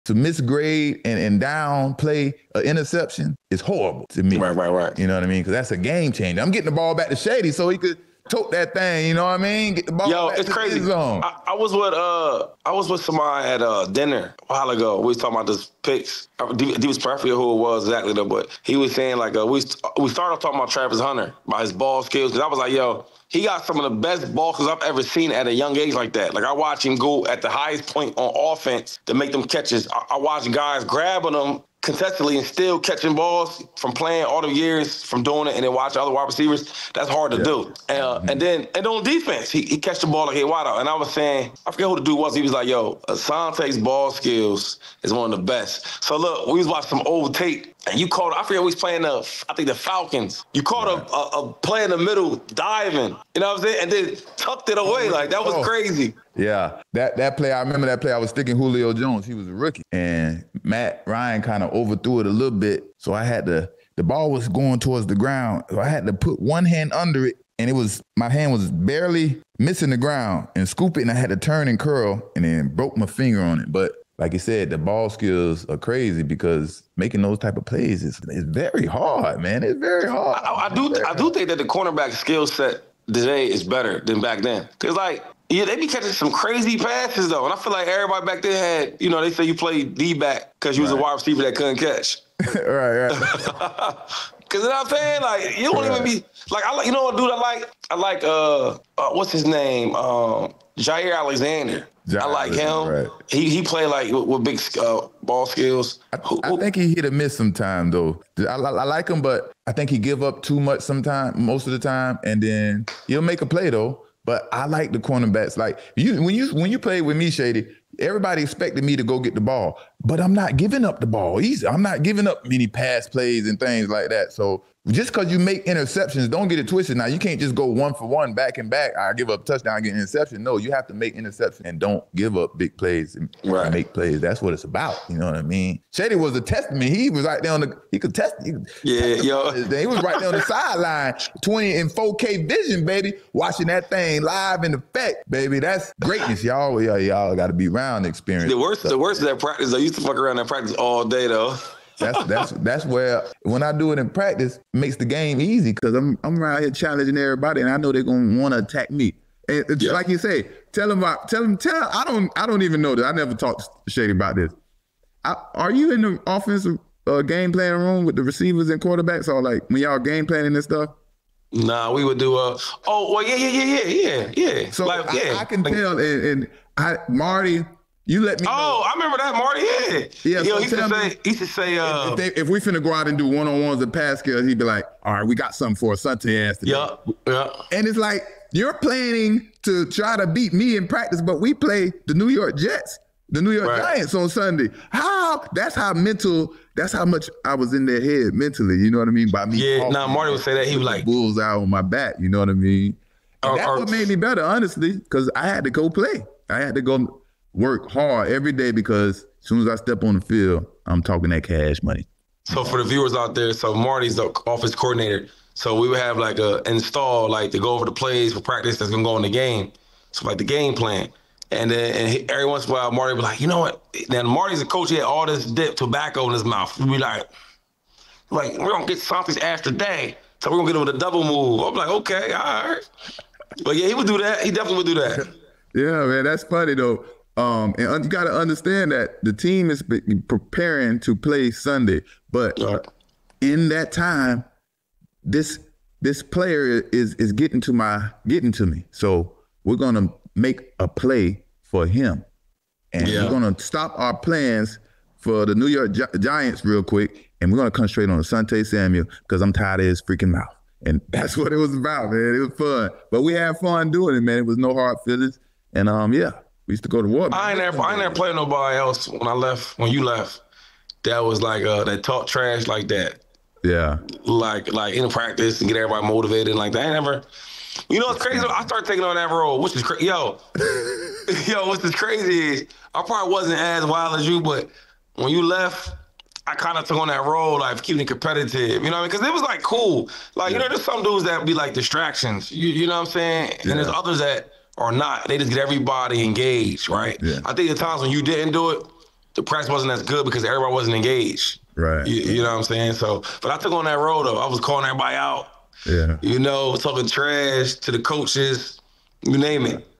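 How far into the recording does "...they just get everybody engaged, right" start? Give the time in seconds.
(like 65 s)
295 s.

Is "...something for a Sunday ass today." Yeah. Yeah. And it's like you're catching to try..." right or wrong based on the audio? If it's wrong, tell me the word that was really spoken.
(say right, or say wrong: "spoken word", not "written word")
wrong: "planning", not "catching".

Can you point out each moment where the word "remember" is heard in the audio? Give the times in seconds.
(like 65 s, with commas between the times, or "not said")
57 s, 178 s.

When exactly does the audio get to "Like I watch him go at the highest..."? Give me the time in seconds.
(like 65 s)
26 s.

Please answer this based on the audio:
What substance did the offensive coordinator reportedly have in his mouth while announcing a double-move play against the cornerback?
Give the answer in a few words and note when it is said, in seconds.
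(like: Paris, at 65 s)
dip tobacco, at 225 s.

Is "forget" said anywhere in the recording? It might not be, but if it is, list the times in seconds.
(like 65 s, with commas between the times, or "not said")
41 s, 48 s.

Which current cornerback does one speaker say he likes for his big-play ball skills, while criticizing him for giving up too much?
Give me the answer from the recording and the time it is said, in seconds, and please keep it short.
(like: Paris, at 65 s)
Jaire Alexander, at 100 s.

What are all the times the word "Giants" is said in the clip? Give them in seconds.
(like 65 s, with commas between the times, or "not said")
193 s, 256 s.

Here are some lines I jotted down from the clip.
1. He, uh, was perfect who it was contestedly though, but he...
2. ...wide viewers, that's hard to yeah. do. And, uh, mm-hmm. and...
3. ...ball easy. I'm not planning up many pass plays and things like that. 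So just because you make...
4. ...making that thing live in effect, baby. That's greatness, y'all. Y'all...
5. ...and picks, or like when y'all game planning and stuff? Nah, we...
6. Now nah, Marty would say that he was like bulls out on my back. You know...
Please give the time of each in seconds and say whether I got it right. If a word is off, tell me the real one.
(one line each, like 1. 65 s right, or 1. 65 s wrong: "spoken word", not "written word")
1. 16 s wrong: "exactly", not "contestedly"
2. 36 s wrong: "receivers", not "viewers"
3. 121 s wrong: "giving", not "planning"
4. 143 s wrong: "watching", not "making"
5. 168 s wrong: "quarterbacks", not "picks"
6. 199 s right.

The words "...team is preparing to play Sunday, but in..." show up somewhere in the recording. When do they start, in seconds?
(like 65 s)
239 s.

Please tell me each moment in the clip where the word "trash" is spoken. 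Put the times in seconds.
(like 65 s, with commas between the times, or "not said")
272 s, 307 s.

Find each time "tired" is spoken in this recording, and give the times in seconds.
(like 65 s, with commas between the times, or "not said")
259 s.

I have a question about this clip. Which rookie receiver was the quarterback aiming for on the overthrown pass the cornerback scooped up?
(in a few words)
Julio Jones.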